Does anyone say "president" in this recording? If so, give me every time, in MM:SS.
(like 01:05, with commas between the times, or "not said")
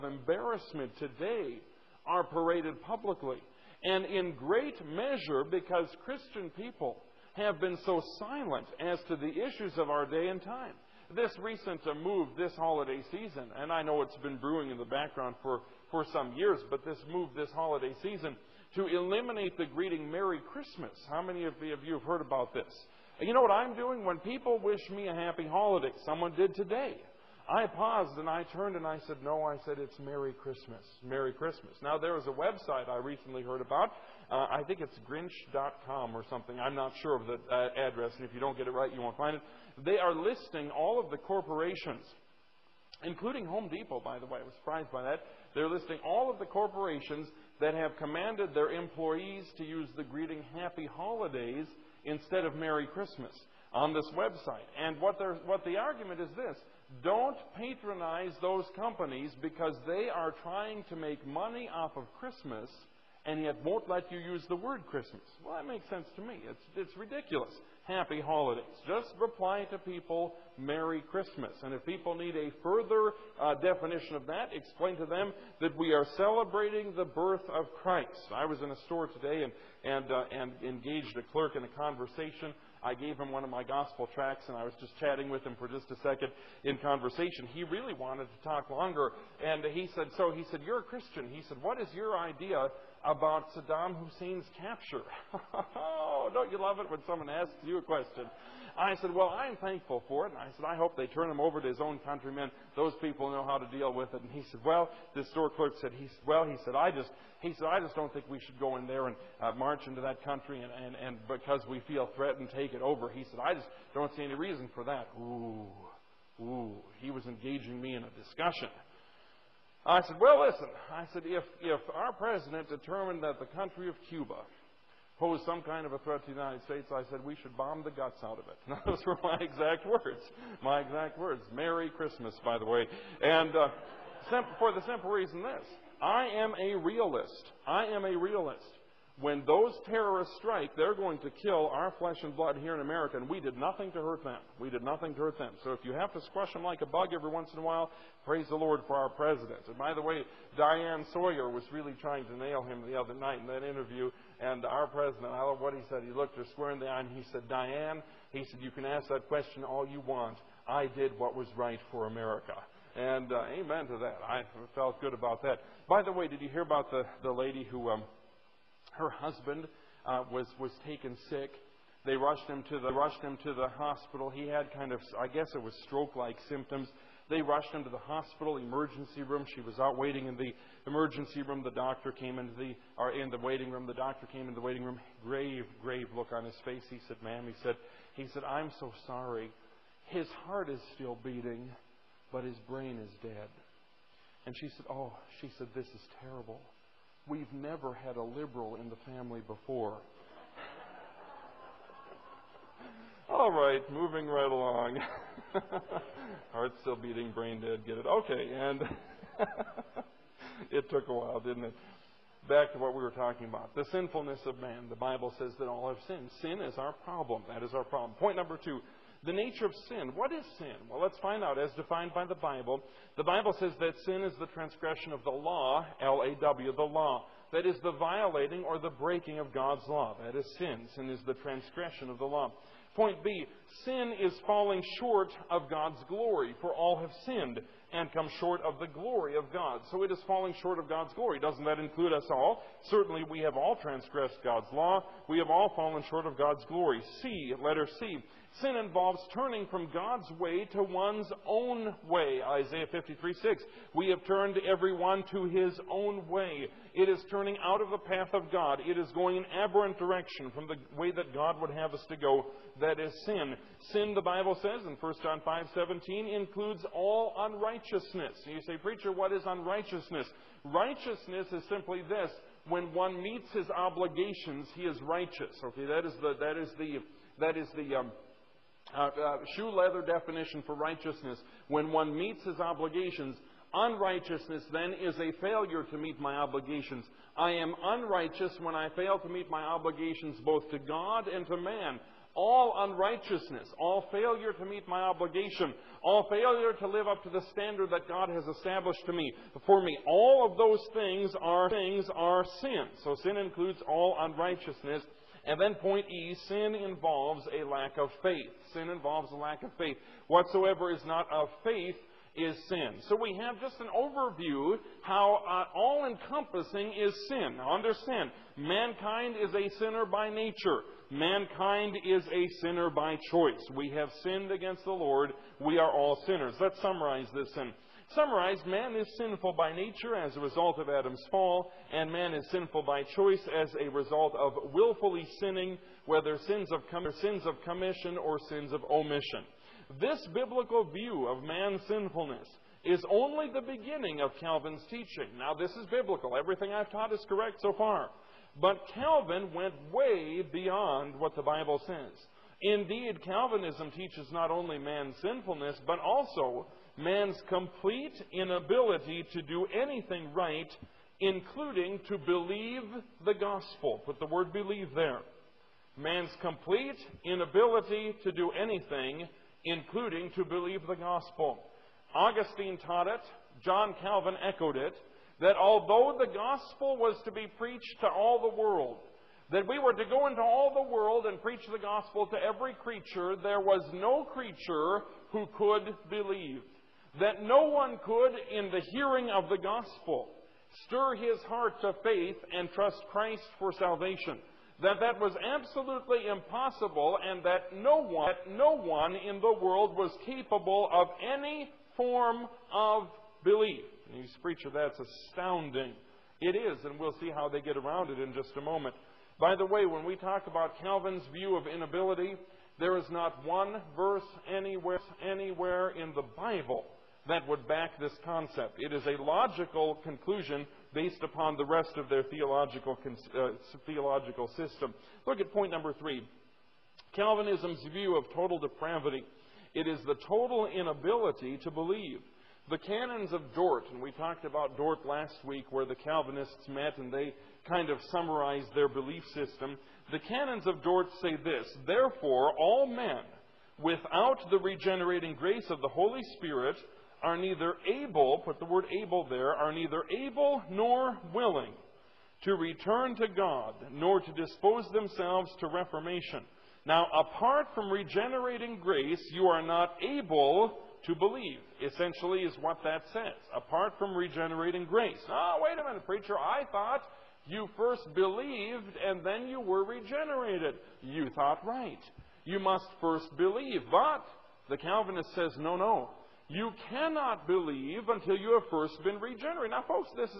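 02:02, 02:29, 02:34.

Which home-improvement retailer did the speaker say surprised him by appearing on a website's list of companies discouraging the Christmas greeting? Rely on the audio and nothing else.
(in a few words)
Home Depot.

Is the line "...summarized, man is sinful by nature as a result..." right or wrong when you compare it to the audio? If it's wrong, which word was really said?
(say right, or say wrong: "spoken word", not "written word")
right.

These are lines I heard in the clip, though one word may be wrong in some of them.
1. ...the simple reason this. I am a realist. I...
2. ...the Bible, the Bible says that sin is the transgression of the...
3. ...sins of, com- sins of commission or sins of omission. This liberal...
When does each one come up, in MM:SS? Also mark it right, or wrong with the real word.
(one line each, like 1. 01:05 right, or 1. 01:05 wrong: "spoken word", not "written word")
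1. 02:14 right
2. 03:42 right
3. 05:36 wrong: "biblical", not "liberal".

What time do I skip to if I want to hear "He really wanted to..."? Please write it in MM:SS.
01:27.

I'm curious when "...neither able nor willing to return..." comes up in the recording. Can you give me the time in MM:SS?
07:29.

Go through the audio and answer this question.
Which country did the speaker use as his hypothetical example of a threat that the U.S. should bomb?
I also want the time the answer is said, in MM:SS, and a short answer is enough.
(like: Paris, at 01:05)
Cuba, at 02:04.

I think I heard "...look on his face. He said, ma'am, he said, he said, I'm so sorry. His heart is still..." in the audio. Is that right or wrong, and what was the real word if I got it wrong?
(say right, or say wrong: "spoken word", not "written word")
right.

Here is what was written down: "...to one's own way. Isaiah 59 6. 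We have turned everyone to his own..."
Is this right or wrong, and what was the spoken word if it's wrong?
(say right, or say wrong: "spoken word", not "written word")
wrong: "53", not "59".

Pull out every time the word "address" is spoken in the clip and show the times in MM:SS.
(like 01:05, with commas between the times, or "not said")
00:37.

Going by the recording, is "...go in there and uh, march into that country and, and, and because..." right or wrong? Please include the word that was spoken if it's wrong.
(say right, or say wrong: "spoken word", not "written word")
right.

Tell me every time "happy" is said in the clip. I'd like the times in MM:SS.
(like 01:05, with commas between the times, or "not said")
00:25, 00:50, 01:07.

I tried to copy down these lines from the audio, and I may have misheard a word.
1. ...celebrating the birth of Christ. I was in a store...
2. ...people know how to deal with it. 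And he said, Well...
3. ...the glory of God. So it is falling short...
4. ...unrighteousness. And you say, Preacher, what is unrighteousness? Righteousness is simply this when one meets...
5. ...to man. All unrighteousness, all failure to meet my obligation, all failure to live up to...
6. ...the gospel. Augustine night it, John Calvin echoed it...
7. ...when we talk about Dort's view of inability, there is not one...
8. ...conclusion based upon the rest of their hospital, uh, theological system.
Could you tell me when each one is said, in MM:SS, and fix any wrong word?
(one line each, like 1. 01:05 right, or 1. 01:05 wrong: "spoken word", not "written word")
1. 01:16 right
2. 01:42 right
3. 03:58 right
4. 04:27 right
5. 04:51 right
6. 06:10 wrong: "taught", not "night"
7. 06:49 wrong: "Calvin", not "Dort"
8. 07:00 wrong: "theological", not "hospital".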